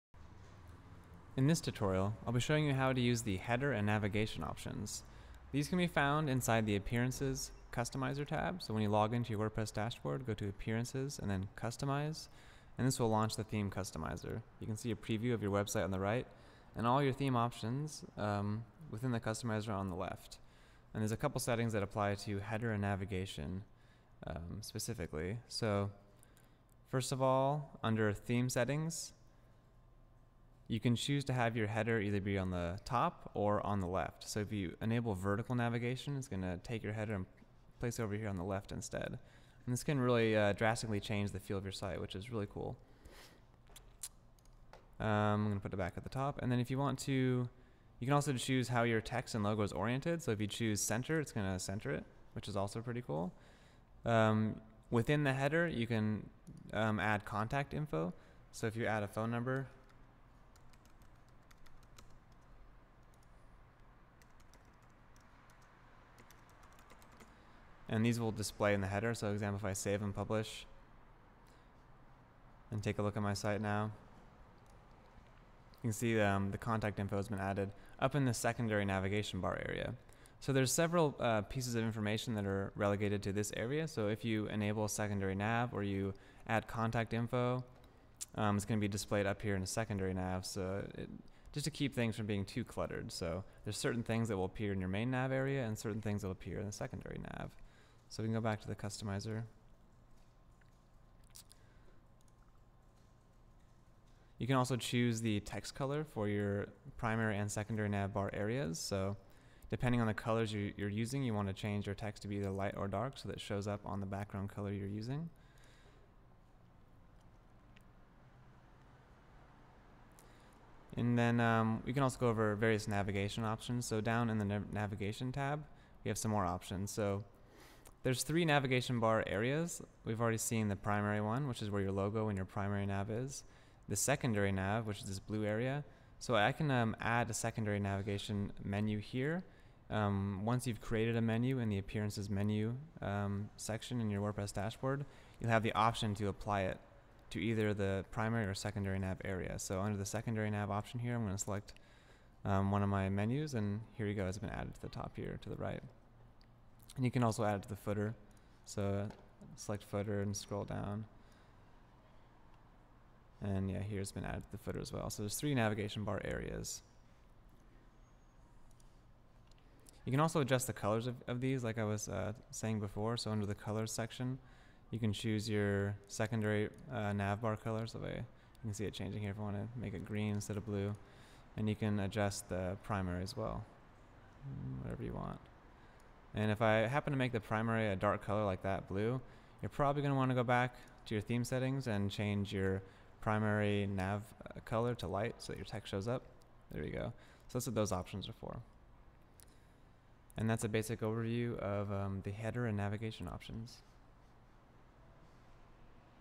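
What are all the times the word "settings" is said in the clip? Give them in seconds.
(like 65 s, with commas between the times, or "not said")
21 s, 28 s, 191 s.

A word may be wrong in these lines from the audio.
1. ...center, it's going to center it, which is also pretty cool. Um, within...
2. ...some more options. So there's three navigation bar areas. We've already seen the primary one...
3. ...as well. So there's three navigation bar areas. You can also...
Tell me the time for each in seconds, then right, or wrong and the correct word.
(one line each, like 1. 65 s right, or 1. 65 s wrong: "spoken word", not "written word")
1. 50 s right
2. 126 s right
3. 164 s right.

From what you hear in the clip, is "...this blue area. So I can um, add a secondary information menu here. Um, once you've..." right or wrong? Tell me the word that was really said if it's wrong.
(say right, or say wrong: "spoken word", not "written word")
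wrong: "navigation", not "information".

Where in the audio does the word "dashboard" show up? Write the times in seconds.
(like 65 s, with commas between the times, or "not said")
9 s, 144 s.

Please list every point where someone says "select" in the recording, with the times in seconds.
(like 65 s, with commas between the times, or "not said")
151 s, 159 s.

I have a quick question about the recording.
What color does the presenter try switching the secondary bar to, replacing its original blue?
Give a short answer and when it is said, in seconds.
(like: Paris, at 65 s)
Green, at 180 s.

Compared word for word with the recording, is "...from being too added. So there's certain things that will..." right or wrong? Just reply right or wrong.
wrong.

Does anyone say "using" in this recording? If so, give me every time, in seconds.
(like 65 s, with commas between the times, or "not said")
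110 s, 114 s.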